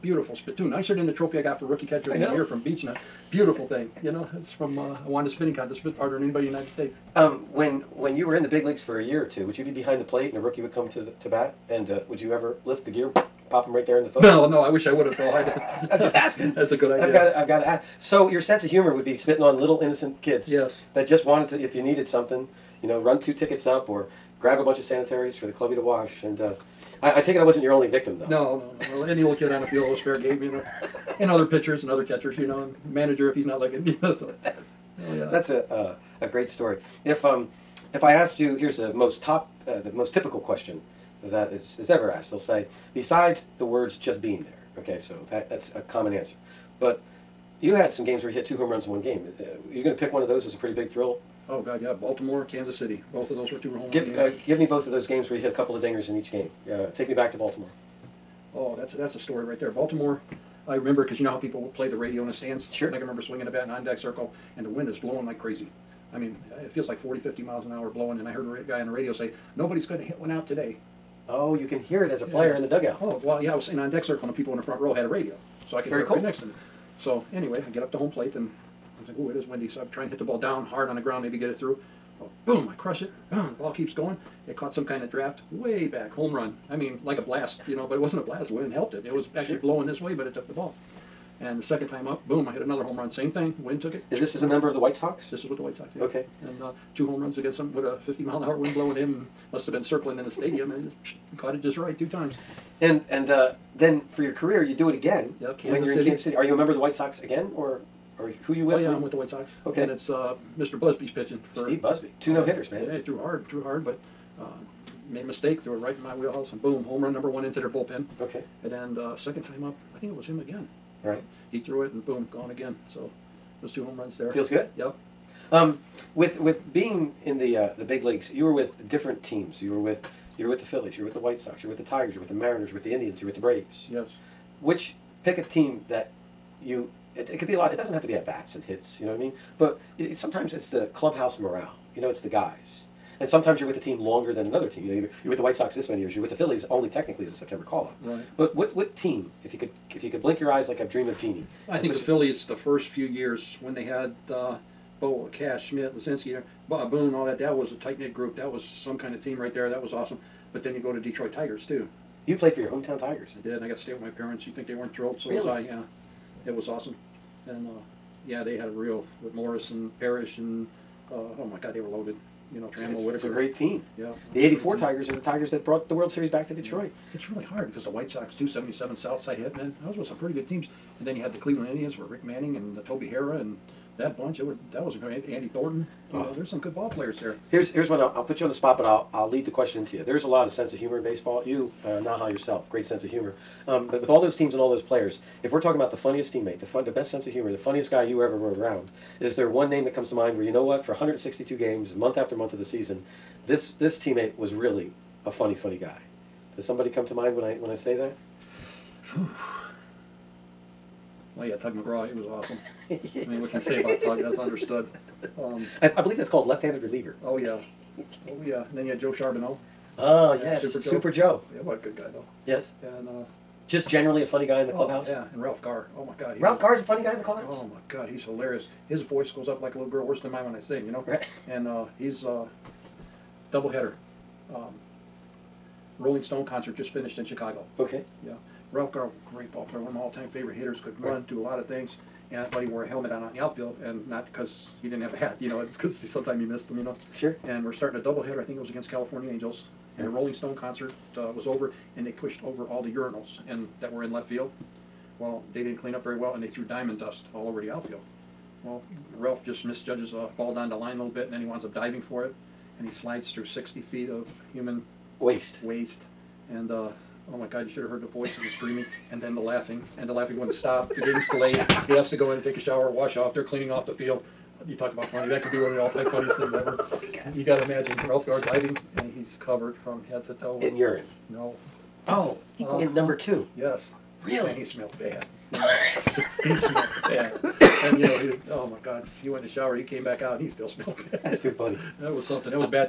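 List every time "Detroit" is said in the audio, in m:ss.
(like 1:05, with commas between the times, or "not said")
2:41, 2:56.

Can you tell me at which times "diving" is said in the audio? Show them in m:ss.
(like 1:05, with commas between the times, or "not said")
4:21, 4:38.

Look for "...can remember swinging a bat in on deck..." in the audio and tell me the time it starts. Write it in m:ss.
1:02.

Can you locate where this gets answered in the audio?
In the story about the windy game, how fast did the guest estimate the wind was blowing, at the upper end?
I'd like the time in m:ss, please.
1:07.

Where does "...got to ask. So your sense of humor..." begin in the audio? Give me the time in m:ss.
0:17.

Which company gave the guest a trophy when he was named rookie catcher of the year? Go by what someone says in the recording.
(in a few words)
Beechnut.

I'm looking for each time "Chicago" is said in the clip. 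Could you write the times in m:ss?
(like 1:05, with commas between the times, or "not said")
3:57.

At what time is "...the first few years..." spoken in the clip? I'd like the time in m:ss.
2:32.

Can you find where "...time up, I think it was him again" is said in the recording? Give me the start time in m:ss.
1:59.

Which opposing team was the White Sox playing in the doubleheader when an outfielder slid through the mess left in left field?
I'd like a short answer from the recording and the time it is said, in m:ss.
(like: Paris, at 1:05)
California Angels, at 4:08.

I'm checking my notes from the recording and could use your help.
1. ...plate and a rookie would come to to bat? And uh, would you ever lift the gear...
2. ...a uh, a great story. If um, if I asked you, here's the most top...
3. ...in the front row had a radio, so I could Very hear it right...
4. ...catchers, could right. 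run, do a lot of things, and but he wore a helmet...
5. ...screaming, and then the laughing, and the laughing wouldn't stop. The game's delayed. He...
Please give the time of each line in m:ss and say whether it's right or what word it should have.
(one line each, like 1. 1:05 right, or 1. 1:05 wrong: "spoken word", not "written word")
1. 0:10 right
2. 0:35 right
3. 1:14 right
4. 4:00 wrong: "hitters", not "catchers"
5. 4:28 right.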